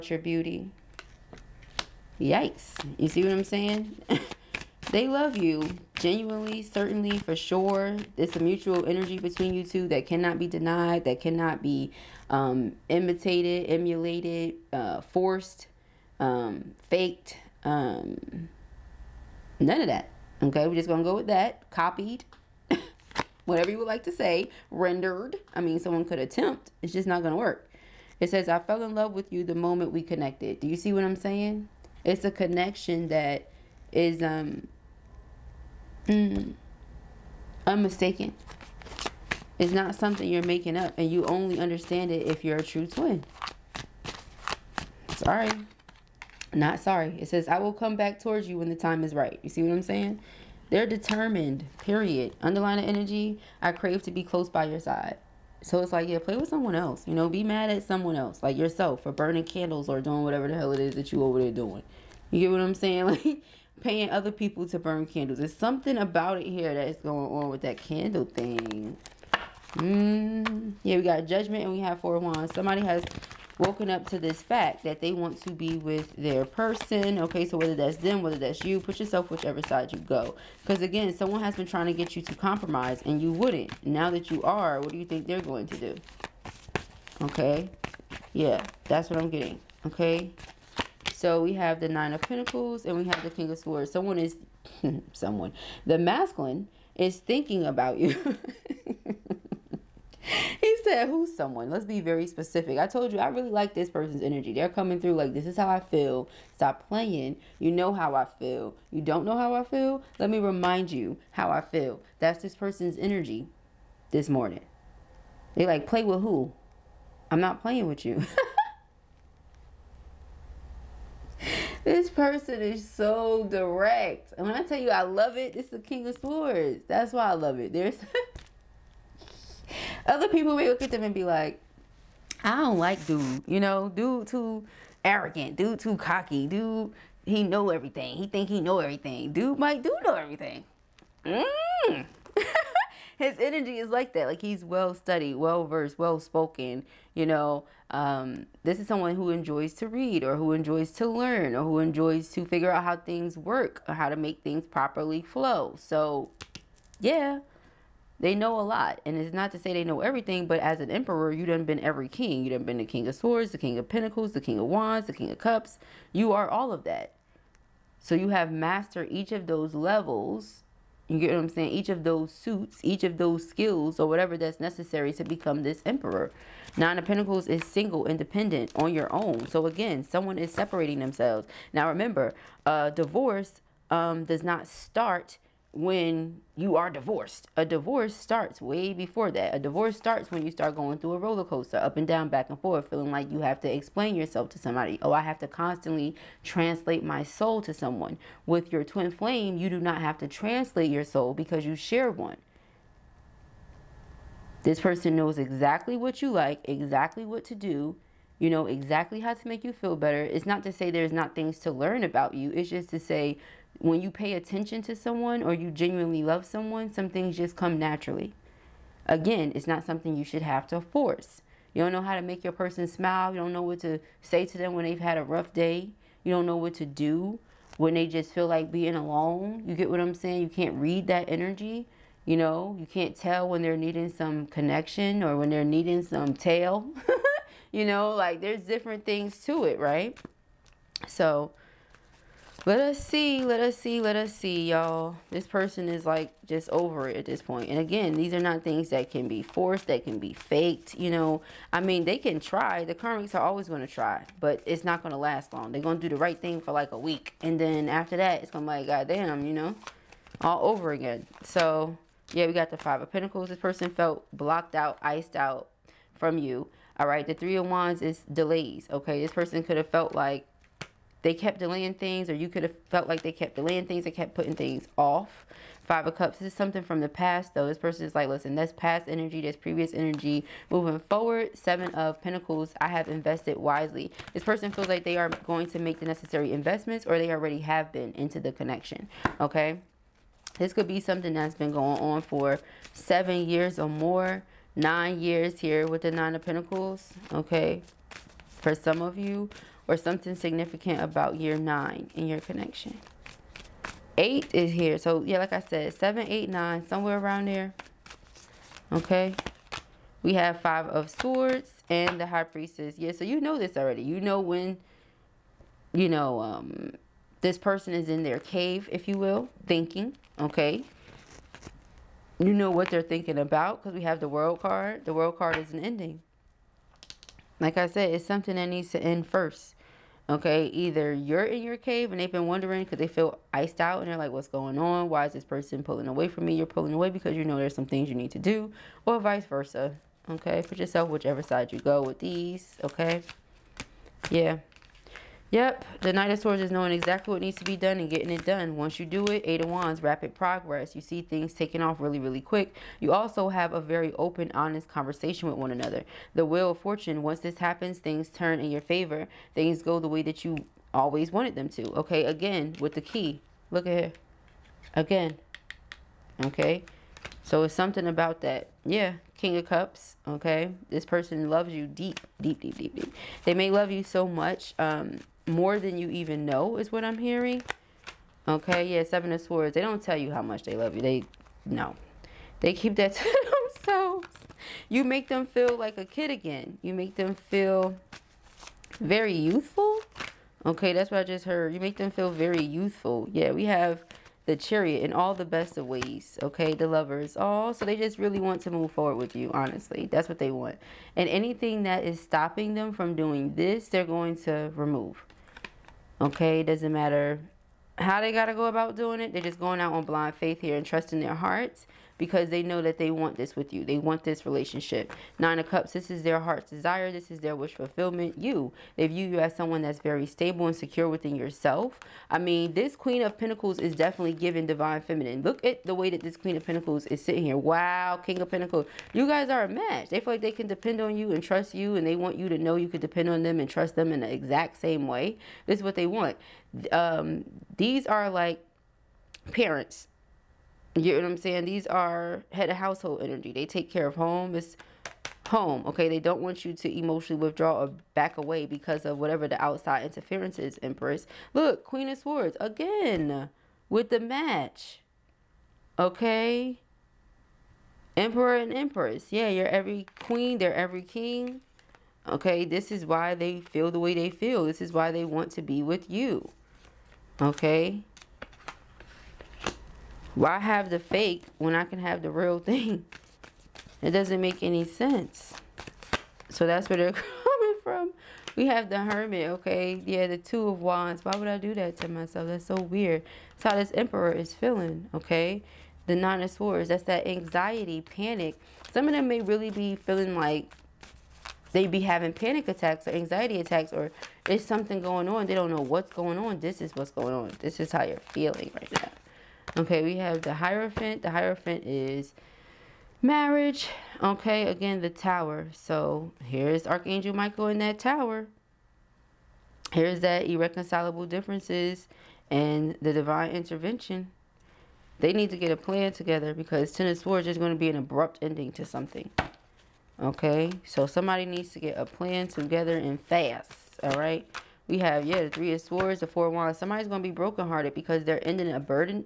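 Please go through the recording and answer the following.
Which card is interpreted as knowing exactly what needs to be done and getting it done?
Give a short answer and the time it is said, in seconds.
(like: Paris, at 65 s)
Knight of Swords, at 346 s.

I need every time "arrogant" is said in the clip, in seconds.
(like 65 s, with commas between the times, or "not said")
135 s.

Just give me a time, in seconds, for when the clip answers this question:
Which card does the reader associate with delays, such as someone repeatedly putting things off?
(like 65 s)
267 s.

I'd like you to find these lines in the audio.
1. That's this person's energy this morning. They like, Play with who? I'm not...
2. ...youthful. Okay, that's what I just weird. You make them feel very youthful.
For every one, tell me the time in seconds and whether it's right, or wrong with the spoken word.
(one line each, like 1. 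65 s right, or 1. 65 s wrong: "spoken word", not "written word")
1. 112 s right
2. 389 s wrong: "heard", not "weird".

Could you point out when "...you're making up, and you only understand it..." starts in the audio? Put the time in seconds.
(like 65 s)
40 s.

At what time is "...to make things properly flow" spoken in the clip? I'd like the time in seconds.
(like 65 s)
154 s.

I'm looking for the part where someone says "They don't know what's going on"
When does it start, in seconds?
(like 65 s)
495 s.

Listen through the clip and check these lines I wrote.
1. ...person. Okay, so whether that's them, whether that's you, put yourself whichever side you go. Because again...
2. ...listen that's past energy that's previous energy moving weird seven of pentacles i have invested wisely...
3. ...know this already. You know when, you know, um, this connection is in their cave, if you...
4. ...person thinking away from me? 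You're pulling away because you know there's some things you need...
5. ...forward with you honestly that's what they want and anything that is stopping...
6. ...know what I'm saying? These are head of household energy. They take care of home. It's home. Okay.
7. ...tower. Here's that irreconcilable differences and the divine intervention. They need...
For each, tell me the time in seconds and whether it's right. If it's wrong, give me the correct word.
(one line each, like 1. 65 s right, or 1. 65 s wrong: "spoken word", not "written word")
1. 76 s right
2. 278 s wrong: "forward", not "weird"
3. 313 s wrong: "person", not "connection"
4. 335 s wrong: "pulling", not "thinking"
5. 398 s right
6. 441 s right
7. 507 s right.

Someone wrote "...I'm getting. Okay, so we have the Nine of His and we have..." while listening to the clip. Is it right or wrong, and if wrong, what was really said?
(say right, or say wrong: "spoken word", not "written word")
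wrong: "Pentacles", not "His".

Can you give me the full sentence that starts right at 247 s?
And again, these are not things that can be forced, that can be faked, you know.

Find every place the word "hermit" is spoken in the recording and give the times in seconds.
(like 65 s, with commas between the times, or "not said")
478 s.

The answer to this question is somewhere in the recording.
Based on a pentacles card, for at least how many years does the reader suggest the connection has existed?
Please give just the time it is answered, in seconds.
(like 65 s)
292 s.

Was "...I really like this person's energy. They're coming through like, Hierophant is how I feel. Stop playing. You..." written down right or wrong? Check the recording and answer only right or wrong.
wrong.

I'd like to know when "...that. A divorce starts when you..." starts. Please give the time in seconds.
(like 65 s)
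189 s.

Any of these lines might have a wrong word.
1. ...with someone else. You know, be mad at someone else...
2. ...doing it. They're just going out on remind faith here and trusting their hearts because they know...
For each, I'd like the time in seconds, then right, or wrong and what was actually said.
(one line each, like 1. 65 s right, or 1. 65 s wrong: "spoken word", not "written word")
1. 56 s right
2. 408 s wrong: "blind", not "remind".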